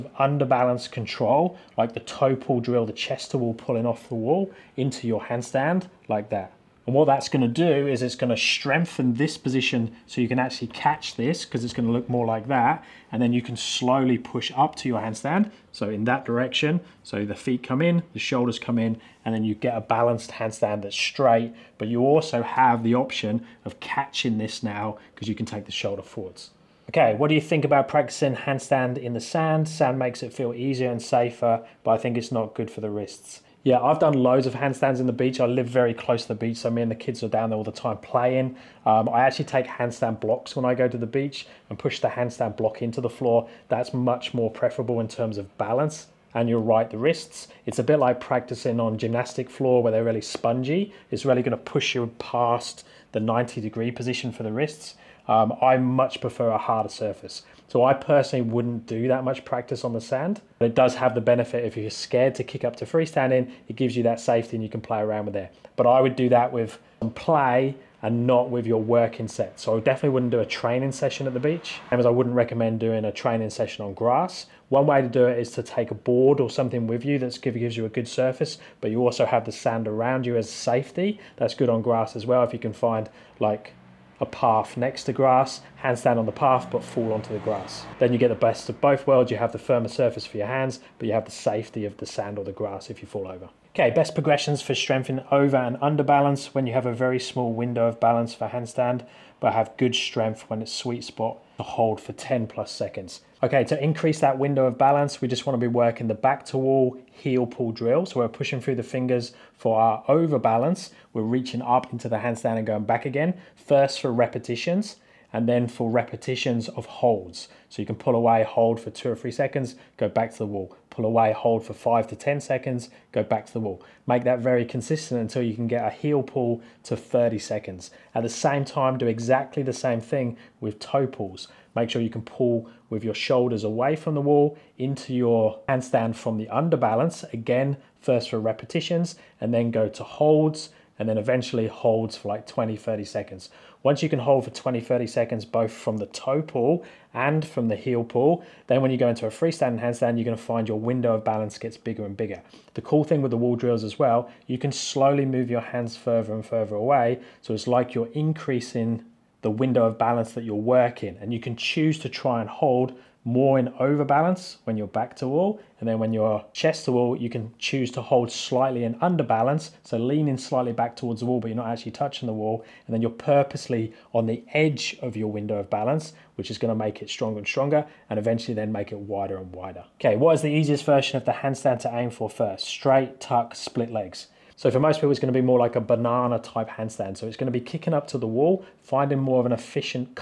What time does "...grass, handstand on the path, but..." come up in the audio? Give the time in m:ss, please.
1:25.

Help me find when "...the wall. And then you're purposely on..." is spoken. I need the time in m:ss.
2:52.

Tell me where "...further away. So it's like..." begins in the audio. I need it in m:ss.
2:36.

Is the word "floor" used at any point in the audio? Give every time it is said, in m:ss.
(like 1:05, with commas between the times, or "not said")
0:43, 0:49.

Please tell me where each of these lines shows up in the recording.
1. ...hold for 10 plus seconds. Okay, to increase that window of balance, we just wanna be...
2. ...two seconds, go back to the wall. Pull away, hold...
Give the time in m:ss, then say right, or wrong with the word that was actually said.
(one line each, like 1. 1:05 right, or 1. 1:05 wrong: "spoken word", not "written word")
1. 1:41 right
2. 1:59 wrong: "three", not "two".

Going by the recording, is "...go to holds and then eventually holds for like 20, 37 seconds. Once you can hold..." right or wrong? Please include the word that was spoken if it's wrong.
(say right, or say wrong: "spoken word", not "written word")
wrong: "30", not "37".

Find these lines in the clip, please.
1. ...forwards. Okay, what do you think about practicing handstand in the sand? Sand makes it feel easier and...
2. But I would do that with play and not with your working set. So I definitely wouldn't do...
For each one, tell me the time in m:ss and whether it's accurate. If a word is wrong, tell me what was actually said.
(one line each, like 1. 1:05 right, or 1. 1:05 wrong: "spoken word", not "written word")
1. 0:26 right
2. 1:05 right.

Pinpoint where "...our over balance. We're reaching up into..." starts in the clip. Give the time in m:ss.
1:49.